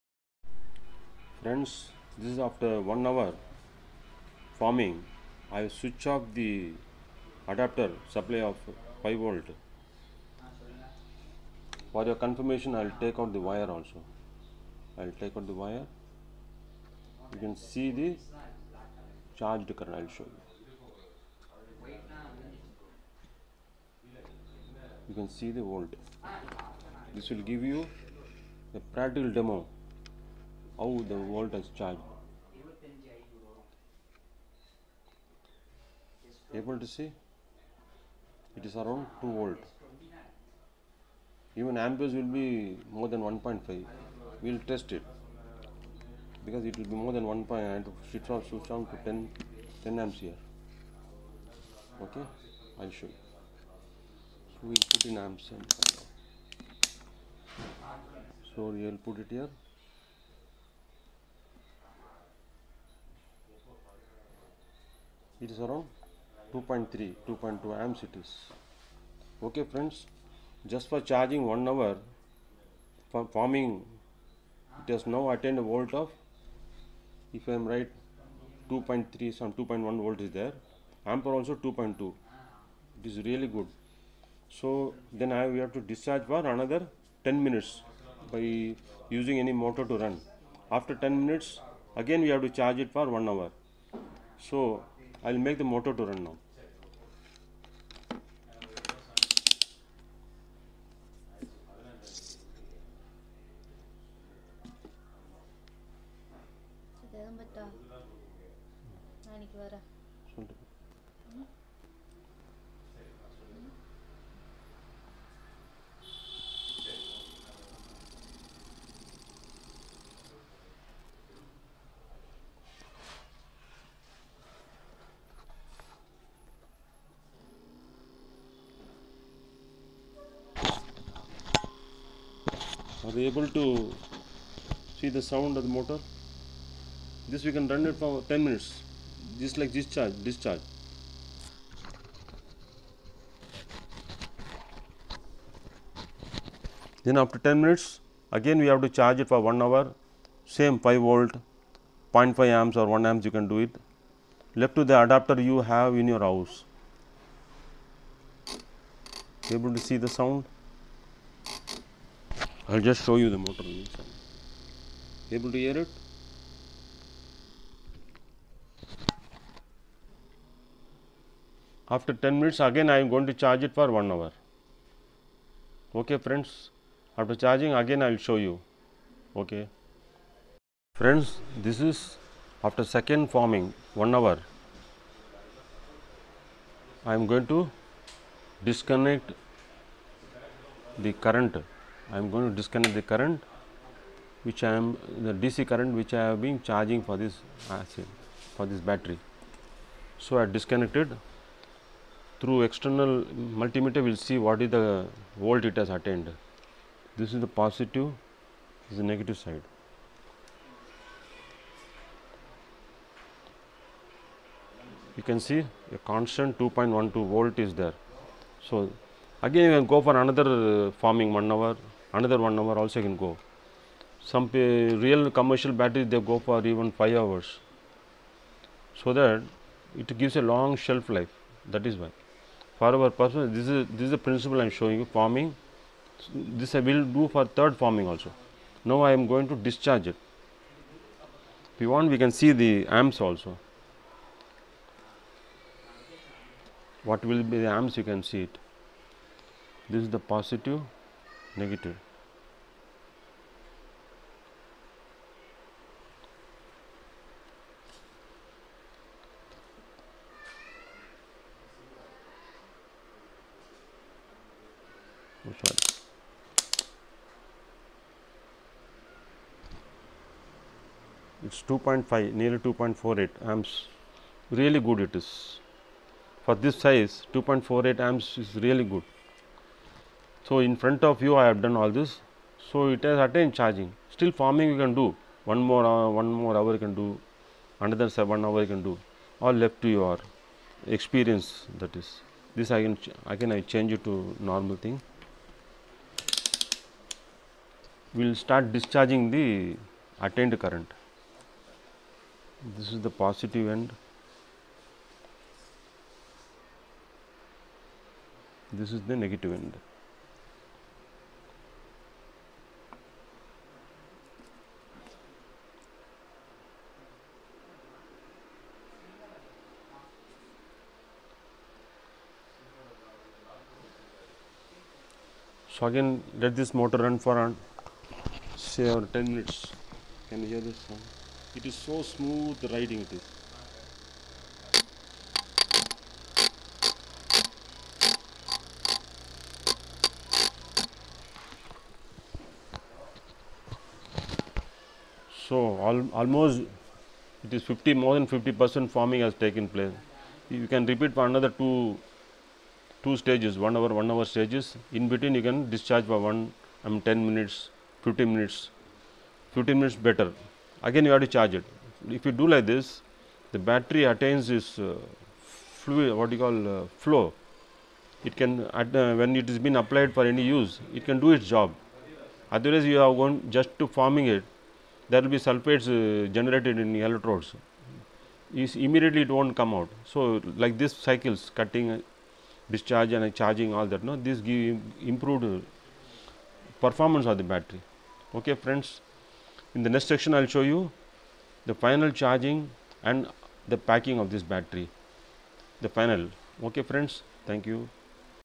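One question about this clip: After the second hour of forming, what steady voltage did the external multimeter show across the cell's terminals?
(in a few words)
2.12 volt.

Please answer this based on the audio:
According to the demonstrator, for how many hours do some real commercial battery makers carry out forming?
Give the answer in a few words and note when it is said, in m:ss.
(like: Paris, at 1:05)
5 hours, at 3:46.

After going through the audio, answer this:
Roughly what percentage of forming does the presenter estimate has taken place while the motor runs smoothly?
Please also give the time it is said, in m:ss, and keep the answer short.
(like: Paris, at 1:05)
more than 50 percent, at 5:47.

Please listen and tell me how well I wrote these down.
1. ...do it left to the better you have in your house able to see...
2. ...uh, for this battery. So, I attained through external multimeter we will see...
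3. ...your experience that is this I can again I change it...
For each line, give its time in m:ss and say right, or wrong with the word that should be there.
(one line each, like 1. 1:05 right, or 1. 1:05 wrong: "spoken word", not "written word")
1. 2:33 wrong: "adapter", not "better"
2. 3:18 wrong: "disconnected", not "attained"
3. 4:49 right.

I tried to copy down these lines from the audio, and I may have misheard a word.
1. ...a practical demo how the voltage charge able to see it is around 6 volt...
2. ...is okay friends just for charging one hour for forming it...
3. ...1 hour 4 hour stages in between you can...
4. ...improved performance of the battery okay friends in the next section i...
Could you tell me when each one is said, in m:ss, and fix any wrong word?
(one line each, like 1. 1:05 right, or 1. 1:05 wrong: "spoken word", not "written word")
1. 0:28 wrong: "2", not "6"
2. 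1:08 right
3. 5:53 wrong: "1", not "4"
4. 6:25 right.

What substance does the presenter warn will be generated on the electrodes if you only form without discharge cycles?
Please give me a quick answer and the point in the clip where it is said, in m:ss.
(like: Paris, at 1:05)
sulfates, at 6:15.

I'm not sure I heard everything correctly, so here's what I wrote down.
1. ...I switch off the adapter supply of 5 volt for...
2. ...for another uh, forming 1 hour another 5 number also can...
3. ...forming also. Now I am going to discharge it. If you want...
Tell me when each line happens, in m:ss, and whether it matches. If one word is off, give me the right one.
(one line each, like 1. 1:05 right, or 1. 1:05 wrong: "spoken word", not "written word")
1. 0:05 right
2. 3:40 wrong: "1", not "5"
3. 3:57 right.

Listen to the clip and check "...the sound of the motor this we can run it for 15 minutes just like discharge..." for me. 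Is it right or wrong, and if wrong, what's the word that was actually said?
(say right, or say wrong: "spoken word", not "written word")
wrong: "10", not "15".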